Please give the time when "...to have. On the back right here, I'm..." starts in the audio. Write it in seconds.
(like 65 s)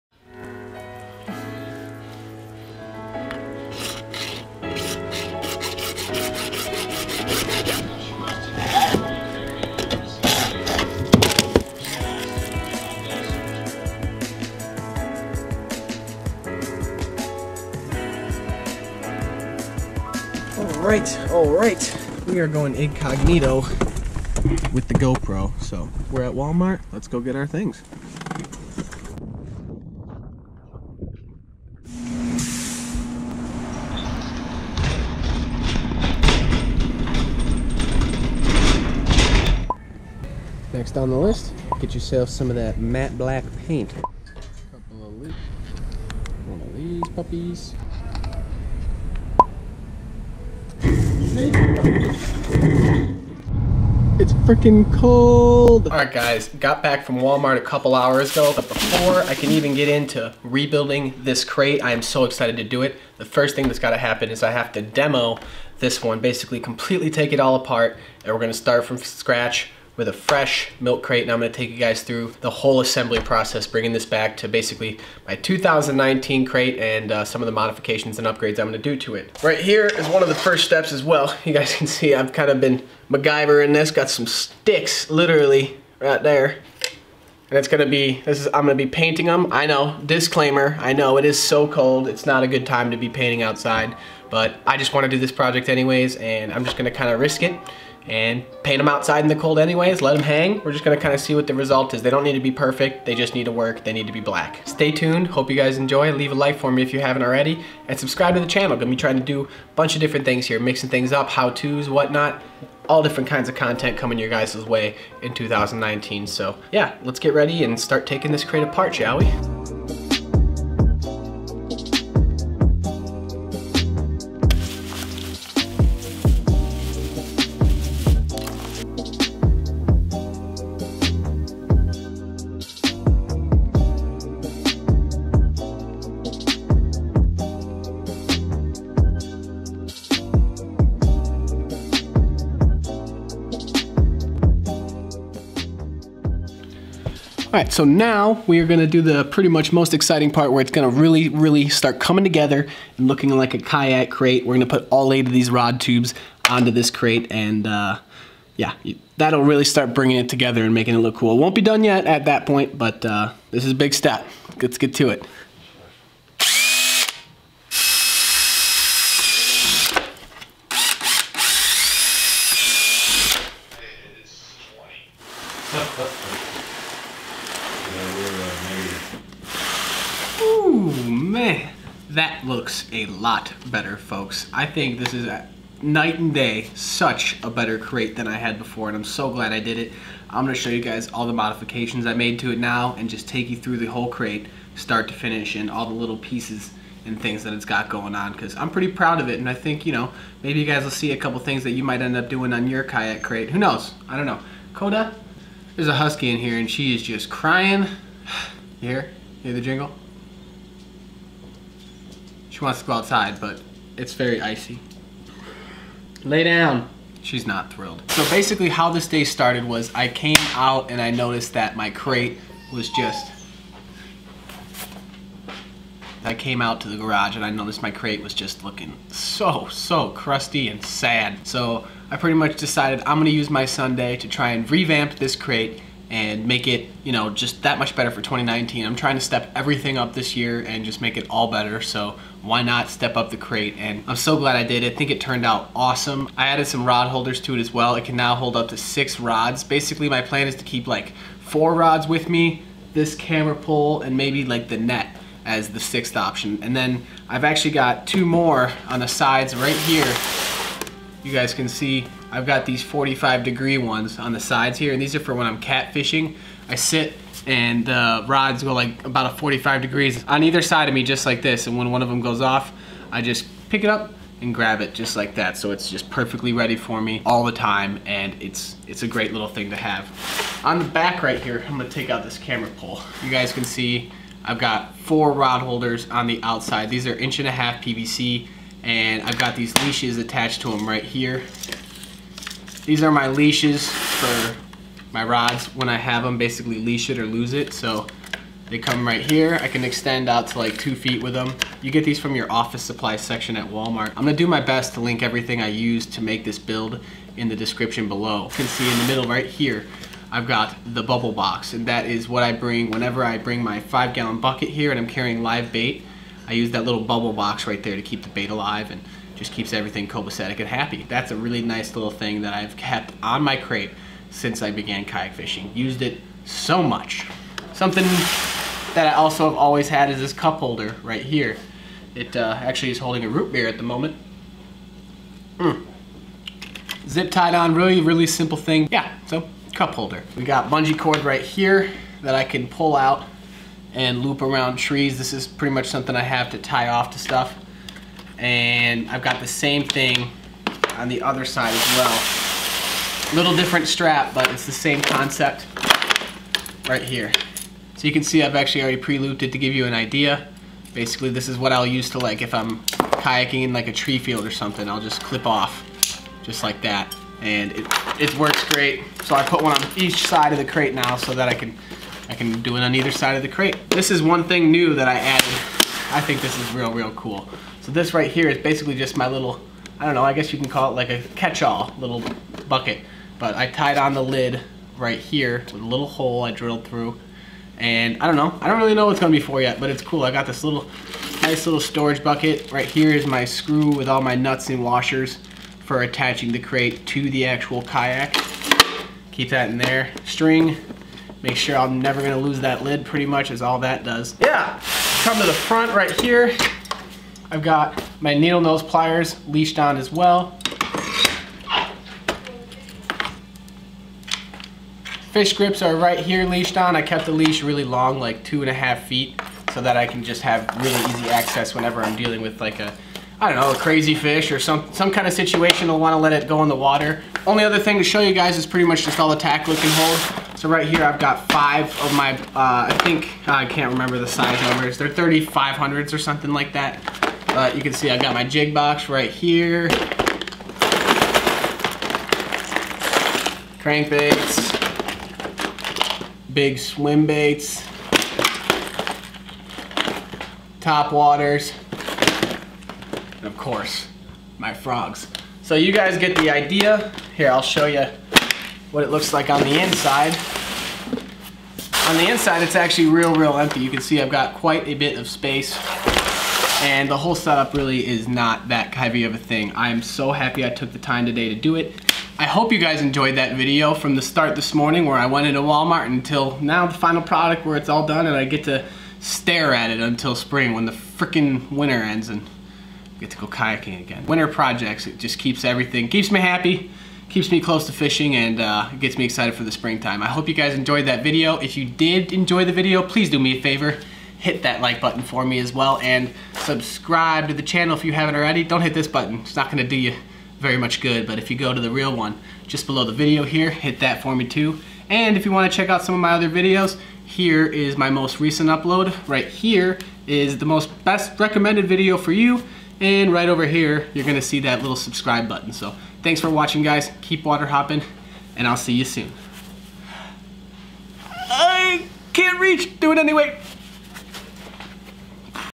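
279 s.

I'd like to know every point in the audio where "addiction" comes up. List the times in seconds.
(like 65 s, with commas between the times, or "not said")
not said.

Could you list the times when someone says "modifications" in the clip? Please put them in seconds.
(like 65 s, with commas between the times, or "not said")
77 s, 191 s.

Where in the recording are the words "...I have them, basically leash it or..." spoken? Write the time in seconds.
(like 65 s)
295 s.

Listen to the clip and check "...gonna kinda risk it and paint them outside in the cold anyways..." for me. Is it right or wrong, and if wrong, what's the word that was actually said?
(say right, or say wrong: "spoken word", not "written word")
right.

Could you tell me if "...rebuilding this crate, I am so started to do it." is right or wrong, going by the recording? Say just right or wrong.
wrong.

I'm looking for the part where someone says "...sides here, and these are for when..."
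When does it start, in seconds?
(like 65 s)
264 s.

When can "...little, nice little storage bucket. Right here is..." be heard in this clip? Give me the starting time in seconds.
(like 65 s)
390 s.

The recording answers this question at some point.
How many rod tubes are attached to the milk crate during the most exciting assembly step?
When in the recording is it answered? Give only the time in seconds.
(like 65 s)
155 s.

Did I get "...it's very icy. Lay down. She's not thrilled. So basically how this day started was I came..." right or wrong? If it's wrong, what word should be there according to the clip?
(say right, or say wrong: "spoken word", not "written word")
right.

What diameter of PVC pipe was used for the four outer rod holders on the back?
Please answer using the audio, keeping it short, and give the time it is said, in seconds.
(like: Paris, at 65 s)
inch and a half, at 287 s.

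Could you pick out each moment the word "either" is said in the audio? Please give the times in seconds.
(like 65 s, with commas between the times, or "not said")
270 s, 372 s.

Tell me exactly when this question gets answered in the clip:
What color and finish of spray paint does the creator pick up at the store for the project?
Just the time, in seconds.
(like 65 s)
42 s.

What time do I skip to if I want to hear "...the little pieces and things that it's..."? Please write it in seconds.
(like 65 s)
195 s.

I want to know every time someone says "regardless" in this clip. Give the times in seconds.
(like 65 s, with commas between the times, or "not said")
not said.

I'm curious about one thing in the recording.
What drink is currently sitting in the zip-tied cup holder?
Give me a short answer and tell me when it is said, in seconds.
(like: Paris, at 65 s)
root beer, at 333 s.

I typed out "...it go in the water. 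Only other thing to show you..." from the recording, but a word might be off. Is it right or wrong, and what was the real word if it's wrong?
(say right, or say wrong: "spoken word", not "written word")
right.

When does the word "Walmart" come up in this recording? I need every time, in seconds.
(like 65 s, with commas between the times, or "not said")
26 s, 57 s, 303 s, 475 s.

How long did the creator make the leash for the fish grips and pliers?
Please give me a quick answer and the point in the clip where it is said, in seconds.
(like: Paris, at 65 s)
2.5 feet, at 418 s.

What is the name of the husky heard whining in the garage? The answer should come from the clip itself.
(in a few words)
Koda.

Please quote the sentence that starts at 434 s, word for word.
They're 3500s or something like that.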